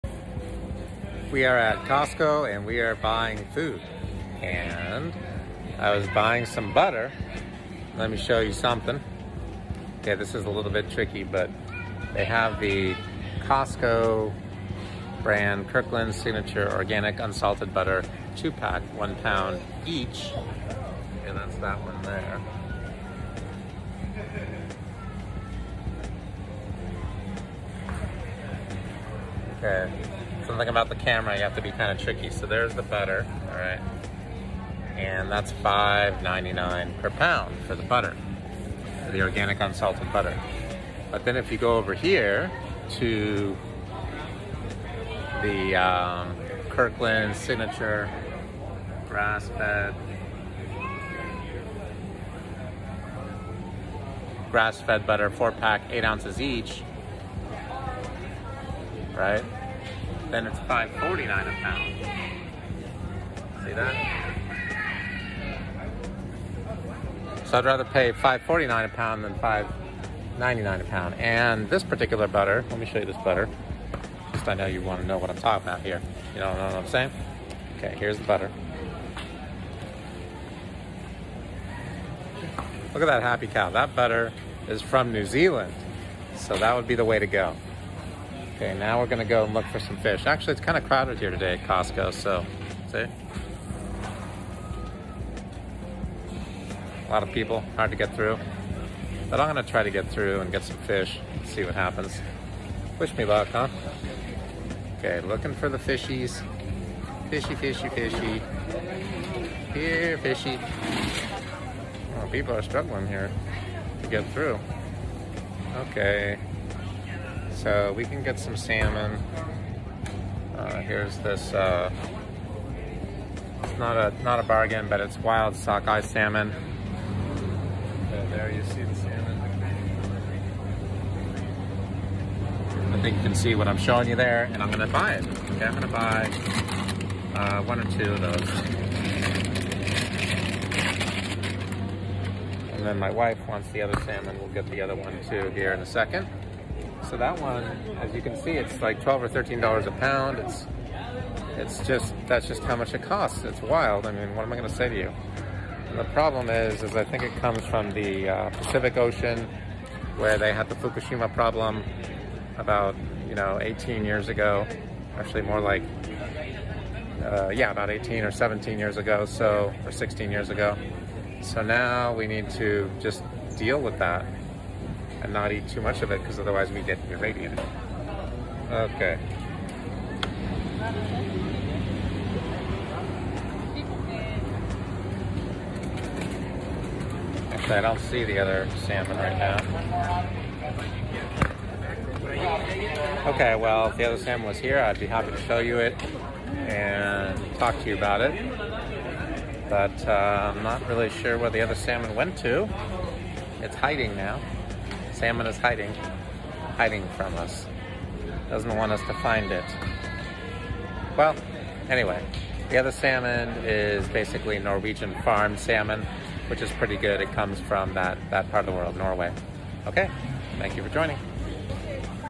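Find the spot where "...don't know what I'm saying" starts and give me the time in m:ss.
1:16.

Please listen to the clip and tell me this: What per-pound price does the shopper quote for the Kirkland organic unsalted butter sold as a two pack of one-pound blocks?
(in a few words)
$5.99.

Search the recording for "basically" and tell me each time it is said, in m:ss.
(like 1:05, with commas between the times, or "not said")
3:34.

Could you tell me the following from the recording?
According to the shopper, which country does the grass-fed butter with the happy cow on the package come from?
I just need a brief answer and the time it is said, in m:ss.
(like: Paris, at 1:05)
New Zealand, at 1:25.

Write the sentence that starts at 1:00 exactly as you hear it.
Then it's five forty nine a pound.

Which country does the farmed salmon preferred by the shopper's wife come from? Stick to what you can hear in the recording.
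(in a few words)
Norway.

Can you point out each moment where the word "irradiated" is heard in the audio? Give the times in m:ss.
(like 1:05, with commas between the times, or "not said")
2:57.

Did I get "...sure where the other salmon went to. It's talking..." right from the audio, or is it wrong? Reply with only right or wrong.
wrong.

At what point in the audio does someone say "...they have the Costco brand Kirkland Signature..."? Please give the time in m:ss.
0:12.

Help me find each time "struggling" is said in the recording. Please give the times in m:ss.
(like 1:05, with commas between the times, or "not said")
1:52.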